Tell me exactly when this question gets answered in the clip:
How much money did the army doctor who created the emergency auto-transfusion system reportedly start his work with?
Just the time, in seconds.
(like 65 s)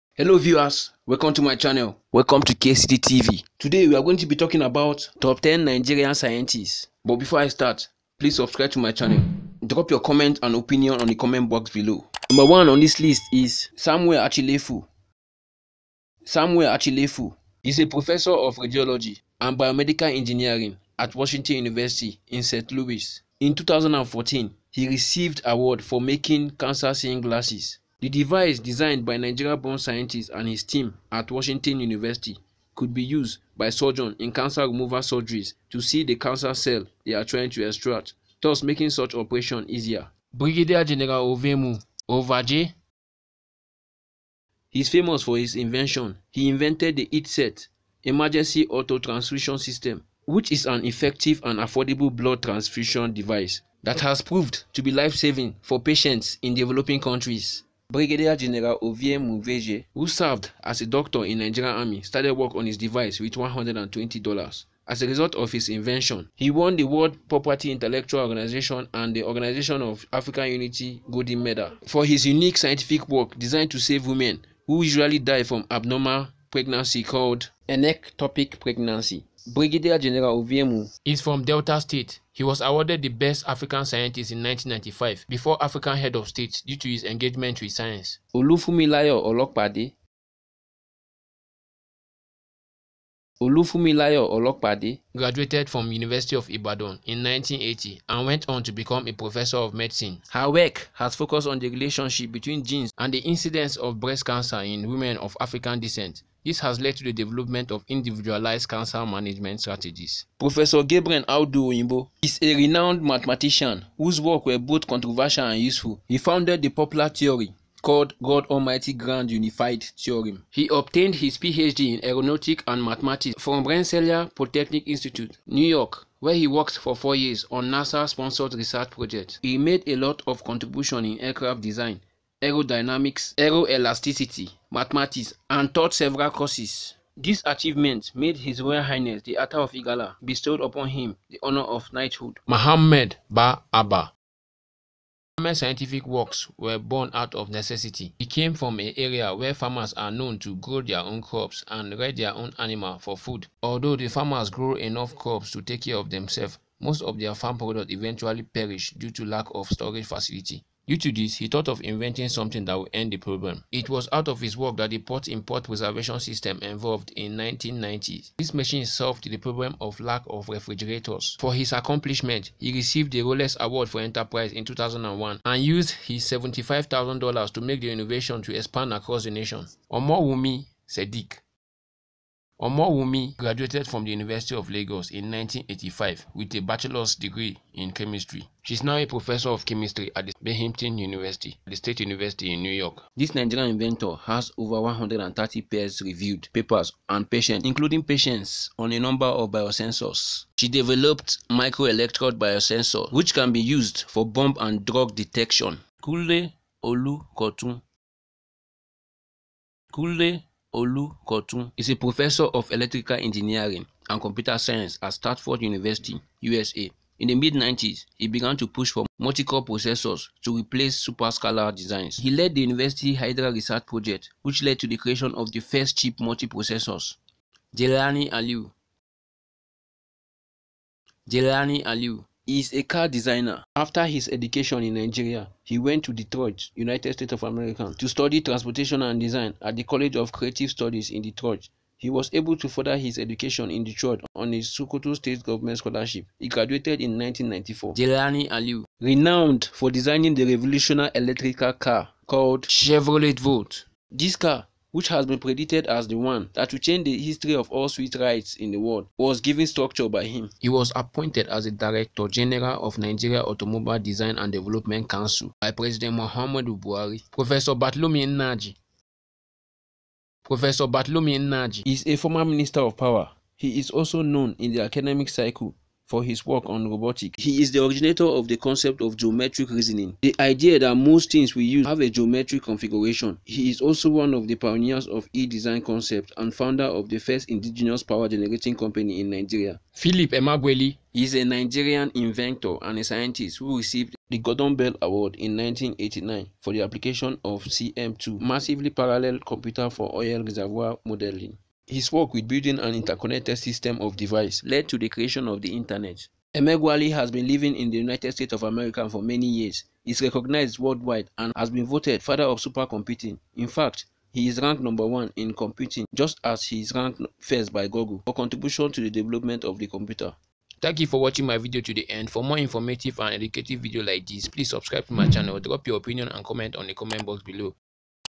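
63 s.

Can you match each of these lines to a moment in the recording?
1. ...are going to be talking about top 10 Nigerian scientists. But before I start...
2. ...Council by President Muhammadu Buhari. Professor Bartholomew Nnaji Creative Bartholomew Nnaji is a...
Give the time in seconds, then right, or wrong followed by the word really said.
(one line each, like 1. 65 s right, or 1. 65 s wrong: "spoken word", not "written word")
1. 3 s right
2. 265 s wrong: "Professor", not "Creative".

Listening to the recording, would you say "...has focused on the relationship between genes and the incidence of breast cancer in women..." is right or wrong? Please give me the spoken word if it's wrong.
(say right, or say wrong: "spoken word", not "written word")
right.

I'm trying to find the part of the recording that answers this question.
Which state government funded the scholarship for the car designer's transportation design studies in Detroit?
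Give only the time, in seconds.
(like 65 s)
244 s.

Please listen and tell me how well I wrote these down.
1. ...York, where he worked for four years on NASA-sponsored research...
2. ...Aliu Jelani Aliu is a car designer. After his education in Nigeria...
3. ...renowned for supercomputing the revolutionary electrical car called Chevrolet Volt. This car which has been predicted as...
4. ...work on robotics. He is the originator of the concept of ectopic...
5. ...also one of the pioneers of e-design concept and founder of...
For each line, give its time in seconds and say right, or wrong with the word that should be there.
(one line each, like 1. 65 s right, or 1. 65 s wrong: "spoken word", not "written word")
1. 125 s right
2. 228 s right
3. 248 s wrong: "designing", not "supercomputing"
4. 276 s wrong: "geometric", not "ectopic"
5. 283 s right.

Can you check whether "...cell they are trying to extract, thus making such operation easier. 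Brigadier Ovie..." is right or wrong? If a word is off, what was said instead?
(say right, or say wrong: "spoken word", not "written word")
wrong: "General", not "Ovie".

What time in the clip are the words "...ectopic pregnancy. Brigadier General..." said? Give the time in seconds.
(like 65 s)
77 s.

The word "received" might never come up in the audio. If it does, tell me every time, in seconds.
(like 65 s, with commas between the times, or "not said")
24 s, 172 s, 293 s.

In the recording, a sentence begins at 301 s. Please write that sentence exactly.
His work with building an interconnected system of devices led to the creation of the Internet.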